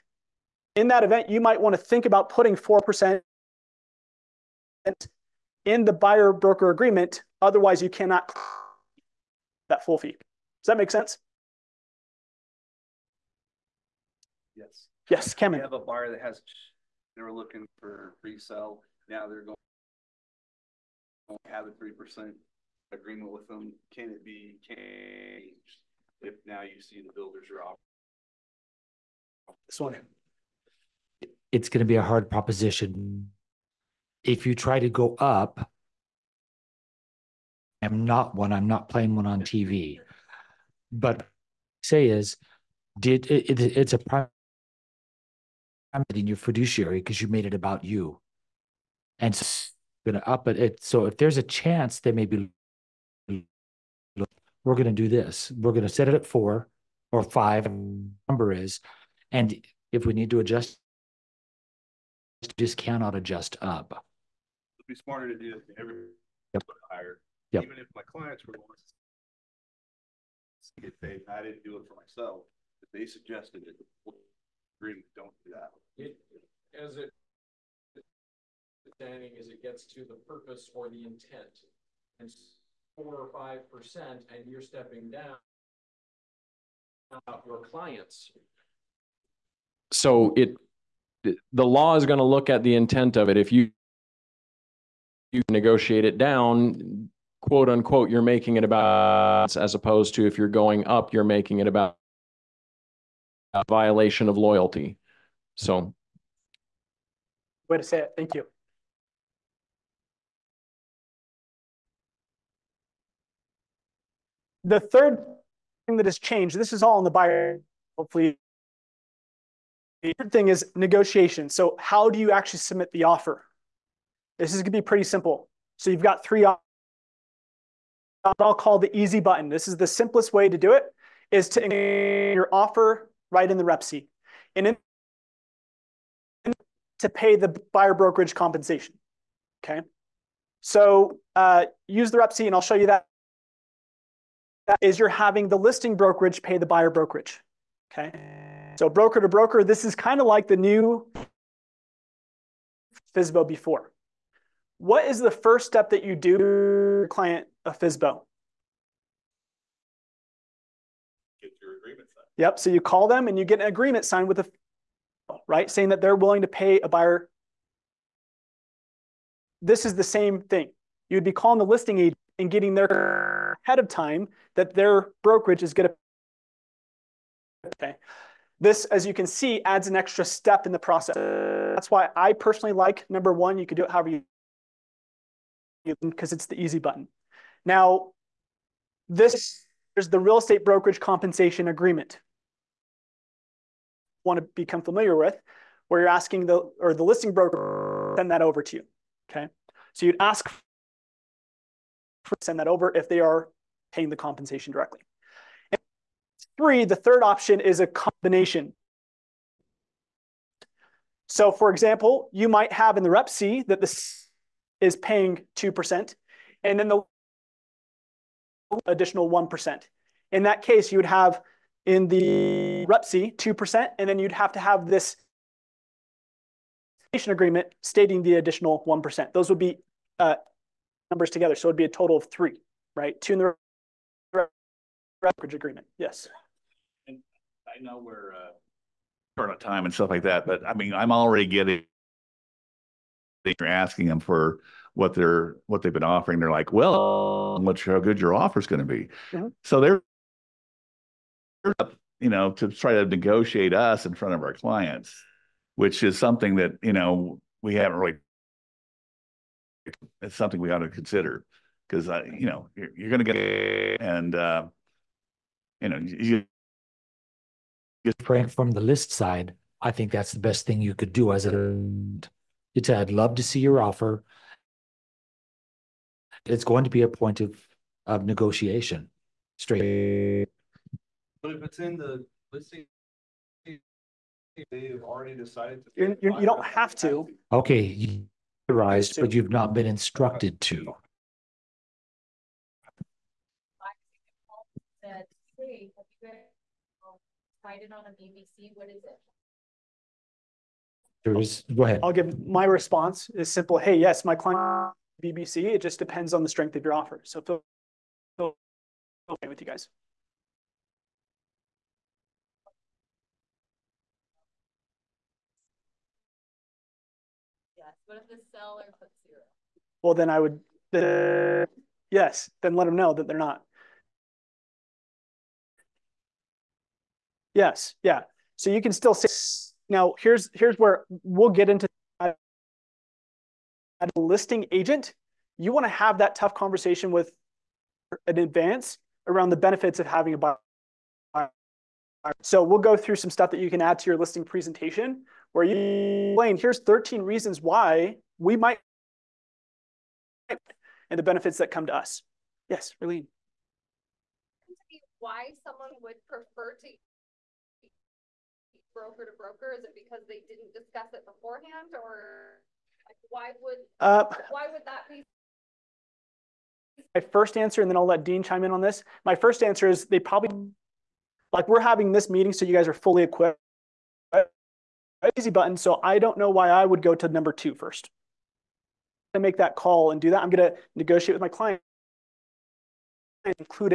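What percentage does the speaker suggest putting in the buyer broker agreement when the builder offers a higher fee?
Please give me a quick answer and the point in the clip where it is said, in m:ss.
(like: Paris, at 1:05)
4%, at 0:02.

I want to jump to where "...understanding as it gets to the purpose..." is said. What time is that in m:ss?
1:18.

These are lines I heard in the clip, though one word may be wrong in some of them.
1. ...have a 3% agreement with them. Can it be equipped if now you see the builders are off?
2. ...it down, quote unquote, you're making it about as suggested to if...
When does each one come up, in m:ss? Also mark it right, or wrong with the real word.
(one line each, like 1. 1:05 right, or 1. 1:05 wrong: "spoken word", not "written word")
1. 0:21 wrong: "changed", not "equipped"
2. 1:36 wrong: "opposed", not "suggested".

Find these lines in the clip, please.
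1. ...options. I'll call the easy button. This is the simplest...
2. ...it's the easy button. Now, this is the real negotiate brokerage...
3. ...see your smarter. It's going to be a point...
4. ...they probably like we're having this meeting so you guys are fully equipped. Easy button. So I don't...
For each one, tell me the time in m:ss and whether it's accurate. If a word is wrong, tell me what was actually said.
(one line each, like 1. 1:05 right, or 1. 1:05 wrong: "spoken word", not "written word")
1. 2:06 right
2. 3:06 wrong: "estate", not "negotiate"
3. 4:33 wrong: "offer", not "smarter"
4. 6:10 right.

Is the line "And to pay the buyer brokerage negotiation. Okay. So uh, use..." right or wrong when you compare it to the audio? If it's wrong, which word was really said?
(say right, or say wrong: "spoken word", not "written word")
wrong: "compensation", not "negotiation".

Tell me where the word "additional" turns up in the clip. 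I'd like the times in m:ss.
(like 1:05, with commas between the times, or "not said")
3:38, 3:48.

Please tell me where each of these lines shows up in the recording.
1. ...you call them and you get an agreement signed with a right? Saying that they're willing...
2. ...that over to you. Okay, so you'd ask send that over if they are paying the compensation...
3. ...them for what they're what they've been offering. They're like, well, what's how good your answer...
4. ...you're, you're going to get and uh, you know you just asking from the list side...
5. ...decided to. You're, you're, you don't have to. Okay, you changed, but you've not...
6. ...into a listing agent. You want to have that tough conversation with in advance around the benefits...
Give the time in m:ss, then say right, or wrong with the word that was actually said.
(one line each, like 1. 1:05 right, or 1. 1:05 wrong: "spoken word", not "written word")
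1. 2:42 right
2. 3:18 right
3. 4:04 wrong: "offer", not "answer"
4. 4:22 wrong: "praying", not "asking"
5. 4:45 wrong: "authorized", not "changed"
6. 5:31 right.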